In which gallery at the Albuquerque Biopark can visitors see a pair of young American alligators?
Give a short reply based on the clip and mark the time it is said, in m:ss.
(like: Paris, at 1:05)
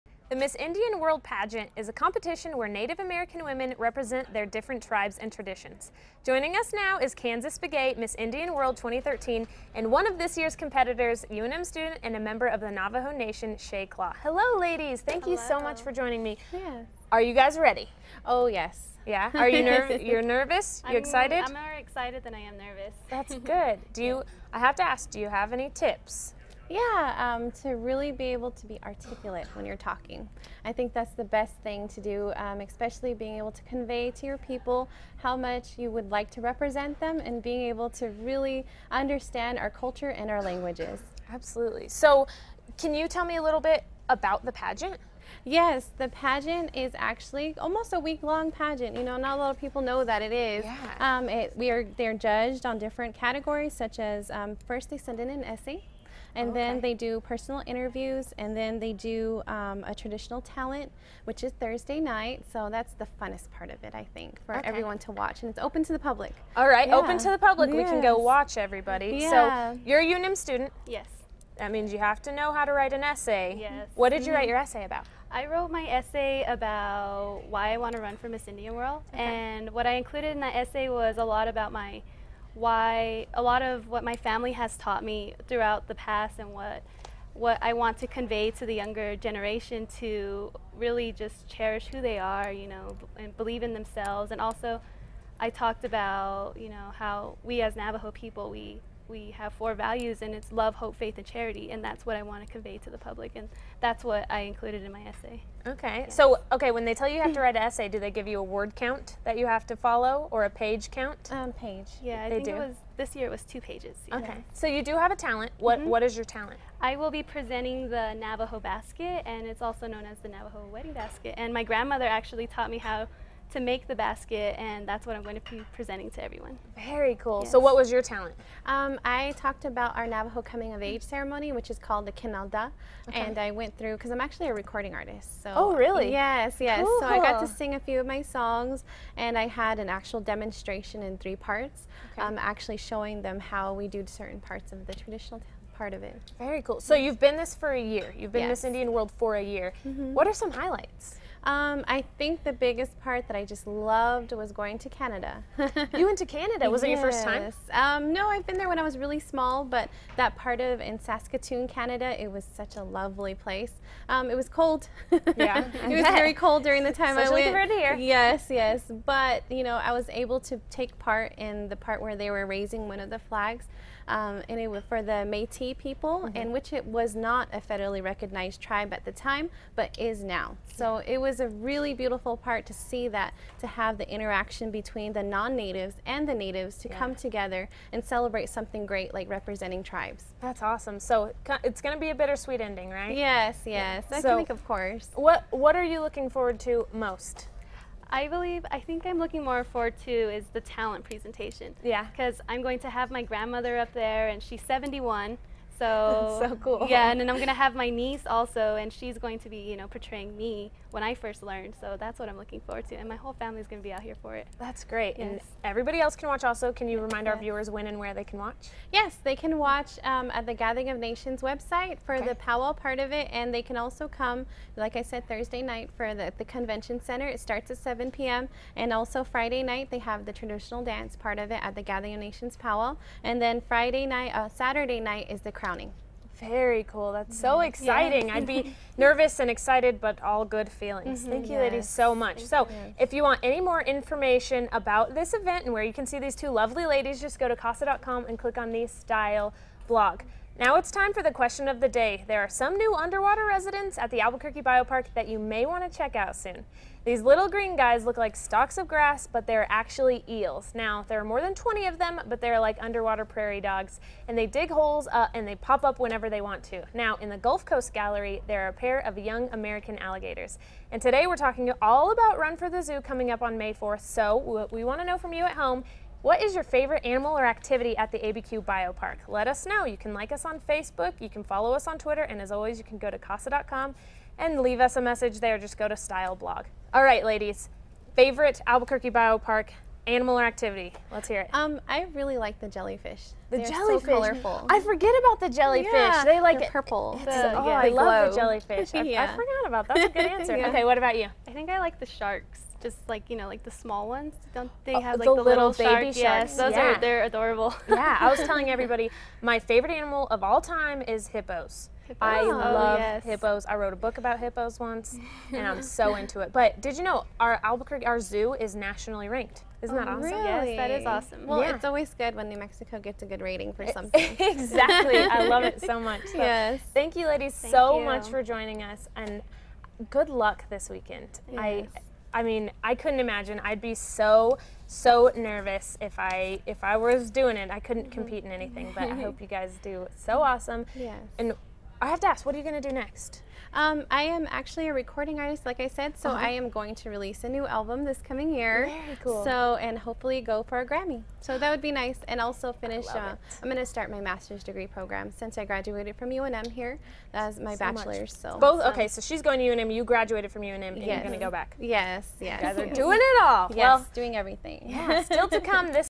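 Gulf Coast Gallery, at 4:27.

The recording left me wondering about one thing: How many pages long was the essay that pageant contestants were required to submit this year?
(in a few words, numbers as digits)
2.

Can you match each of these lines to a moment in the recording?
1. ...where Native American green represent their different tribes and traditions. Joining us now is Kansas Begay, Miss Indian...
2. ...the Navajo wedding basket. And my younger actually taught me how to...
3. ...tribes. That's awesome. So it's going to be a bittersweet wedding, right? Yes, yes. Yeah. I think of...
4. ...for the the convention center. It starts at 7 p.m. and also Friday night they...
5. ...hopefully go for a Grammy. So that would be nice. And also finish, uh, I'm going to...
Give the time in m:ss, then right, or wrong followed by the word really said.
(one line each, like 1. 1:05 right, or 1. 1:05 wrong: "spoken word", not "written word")
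1. 0:02 wrong: "women", not "green"
2. 2:00 wrong: "grandmother", not "younger"
3. 3:09 wrong: "ending", not "wedding"
4. 3:45 right
5. 5:49 right.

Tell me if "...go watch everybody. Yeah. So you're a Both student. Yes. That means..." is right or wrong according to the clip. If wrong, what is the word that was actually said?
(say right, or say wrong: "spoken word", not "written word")
wrong: "UNM", not "Both".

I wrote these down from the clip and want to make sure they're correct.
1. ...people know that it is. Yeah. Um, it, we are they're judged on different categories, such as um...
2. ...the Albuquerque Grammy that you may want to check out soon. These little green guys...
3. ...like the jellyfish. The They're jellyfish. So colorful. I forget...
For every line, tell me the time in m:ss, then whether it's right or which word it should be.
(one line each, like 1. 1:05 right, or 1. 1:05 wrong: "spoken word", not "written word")
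1. 0:49 right
2. 4:14 wrong: "Biopark", not "Grammy"
3. 4:52 right.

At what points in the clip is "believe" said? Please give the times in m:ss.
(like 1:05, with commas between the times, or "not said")
1:33, 3:18.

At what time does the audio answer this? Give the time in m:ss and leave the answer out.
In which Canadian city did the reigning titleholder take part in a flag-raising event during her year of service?
2:40.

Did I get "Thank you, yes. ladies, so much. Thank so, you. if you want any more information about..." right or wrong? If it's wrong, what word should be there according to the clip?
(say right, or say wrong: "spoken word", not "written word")
right.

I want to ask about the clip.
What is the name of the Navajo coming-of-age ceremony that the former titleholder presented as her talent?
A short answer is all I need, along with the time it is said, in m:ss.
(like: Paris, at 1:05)
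Kinalda, at 2:12.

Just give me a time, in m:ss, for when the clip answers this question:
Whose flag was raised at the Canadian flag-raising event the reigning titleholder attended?
2:55.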